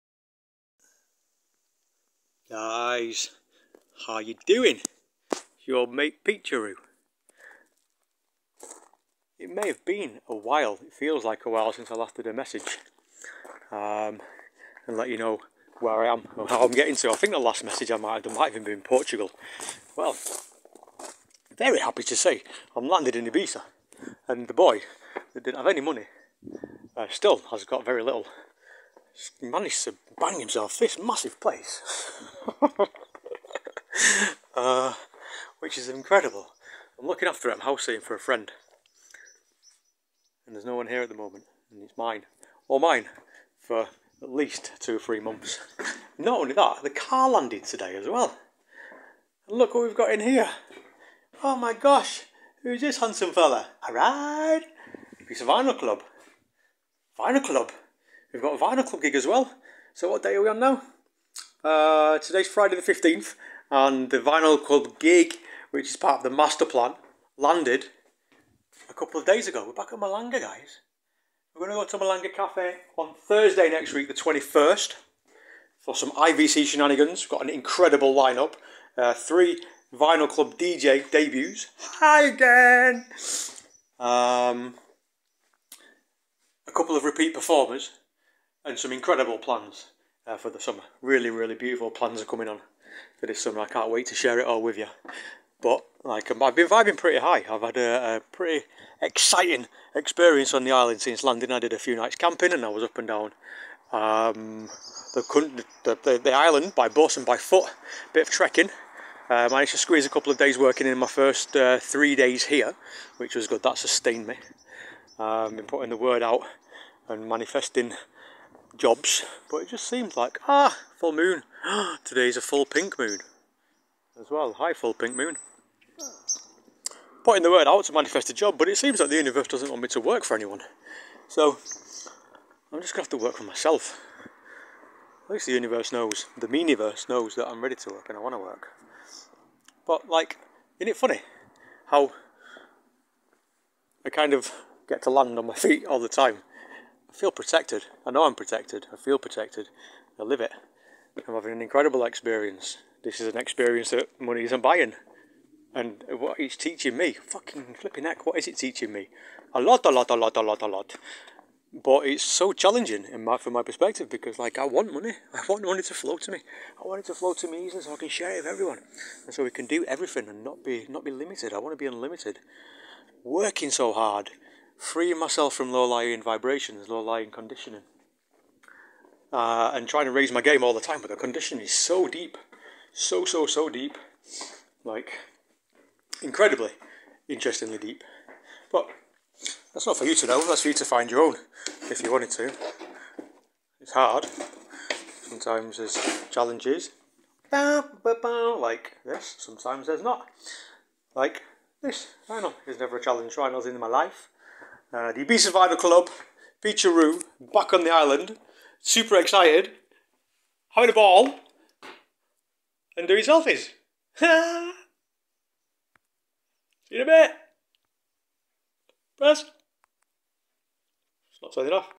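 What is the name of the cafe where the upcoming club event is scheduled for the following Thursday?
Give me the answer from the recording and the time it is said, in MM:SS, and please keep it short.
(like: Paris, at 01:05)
Malanga Cafe, at 01:12.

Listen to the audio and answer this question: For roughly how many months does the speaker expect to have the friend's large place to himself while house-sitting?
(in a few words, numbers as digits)
2 or 3 months.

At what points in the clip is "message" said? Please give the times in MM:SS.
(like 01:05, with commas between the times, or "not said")
00:12, 00:17.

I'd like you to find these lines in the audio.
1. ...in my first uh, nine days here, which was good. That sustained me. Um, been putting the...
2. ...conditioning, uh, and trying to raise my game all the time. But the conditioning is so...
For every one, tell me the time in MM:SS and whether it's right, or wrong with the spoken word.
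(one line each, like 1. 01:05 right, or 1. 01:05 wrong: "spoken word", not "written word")
1. 01:50 wrong: "three", not "nine"
2. 02:57 right.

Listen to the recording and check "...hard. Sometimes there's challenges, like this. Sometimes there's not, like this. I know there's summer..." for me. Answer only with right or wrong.
wrong.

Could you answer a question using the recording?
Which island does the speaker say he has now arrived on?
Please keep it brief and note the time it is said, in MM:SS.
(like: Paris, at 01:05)
Ibiza, at 00:23.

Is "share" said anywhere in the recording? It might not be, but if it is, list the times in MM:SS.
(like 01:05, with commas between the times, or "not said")
01:34, 02:48.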